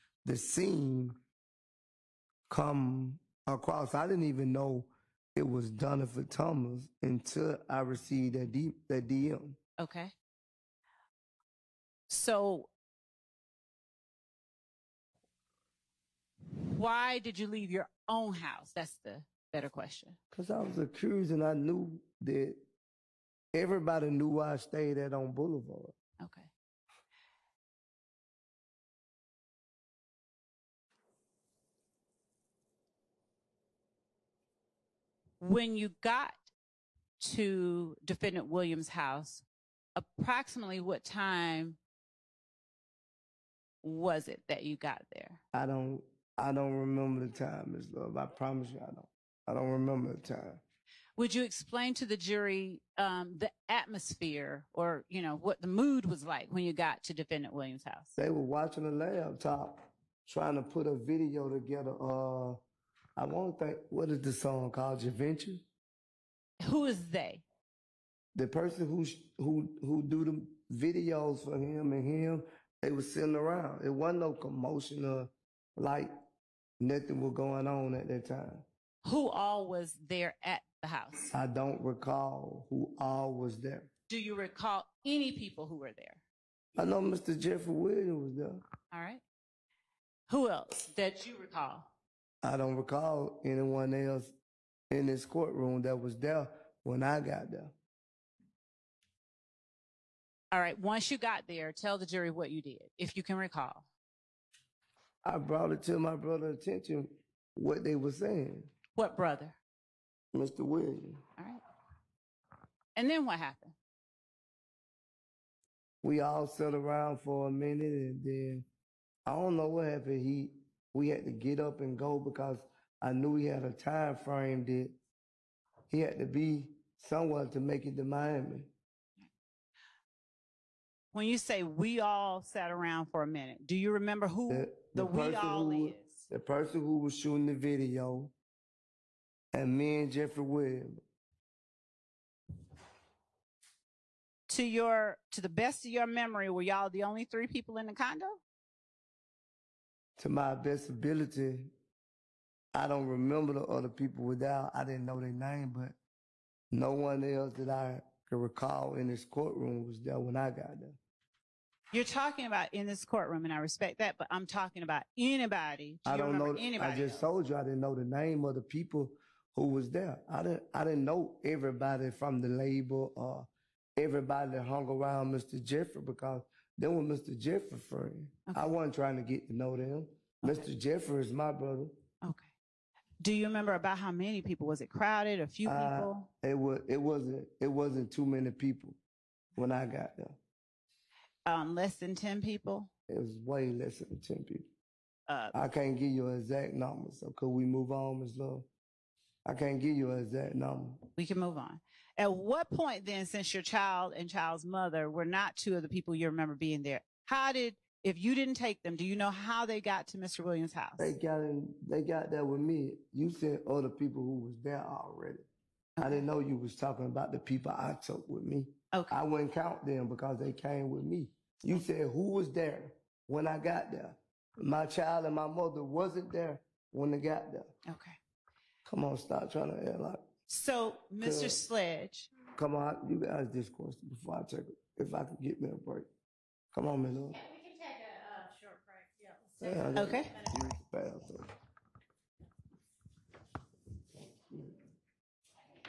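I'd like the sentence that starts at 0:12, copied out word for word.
So why did you leave your own house?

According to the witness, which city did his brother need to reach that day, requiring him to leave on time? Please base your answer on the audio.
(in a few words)
Miami.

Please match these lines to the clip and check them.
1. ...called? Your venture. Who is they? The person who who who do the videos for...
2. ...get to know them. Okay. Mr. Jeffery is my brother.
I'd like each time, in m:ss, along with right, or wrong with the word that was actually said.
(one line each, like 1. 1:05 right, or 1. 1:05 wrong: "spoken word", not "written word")
1. 1:04 right
2. 2:59 right.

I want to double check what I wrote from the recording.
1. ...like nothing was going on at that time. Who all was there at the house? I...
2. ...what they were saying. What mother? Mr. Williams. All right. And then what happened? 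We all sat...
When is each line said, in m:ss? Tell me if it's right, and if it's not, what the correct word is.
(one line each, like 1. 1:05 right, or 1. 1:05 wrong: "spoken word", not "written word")
1. 1:15 right
2. 1:47 wrong: "brother", not "mother".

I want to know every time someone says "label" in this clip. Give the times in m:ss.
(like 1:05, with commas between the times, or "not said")
2:52.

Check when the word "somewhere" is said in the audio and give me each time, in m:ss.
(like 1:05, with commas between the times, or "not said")
2:07.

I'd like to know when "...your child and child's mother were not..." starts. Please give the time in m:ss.
3:23.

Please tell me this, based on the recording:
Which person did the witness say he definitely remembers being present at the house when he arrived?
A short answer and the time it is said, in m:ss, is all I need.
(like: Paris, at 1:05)
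Jeffery Williams, at 1:27.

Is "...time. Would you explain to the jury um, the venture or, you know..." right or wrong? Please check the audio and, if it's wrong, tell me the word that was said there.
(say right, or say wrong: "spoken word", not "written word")
wrong: "atmosphere", not "venture".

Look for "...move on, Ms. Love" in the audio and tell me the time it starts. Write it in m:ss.
3:17.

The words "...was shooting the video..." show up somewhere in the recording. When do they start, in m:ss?
2:16.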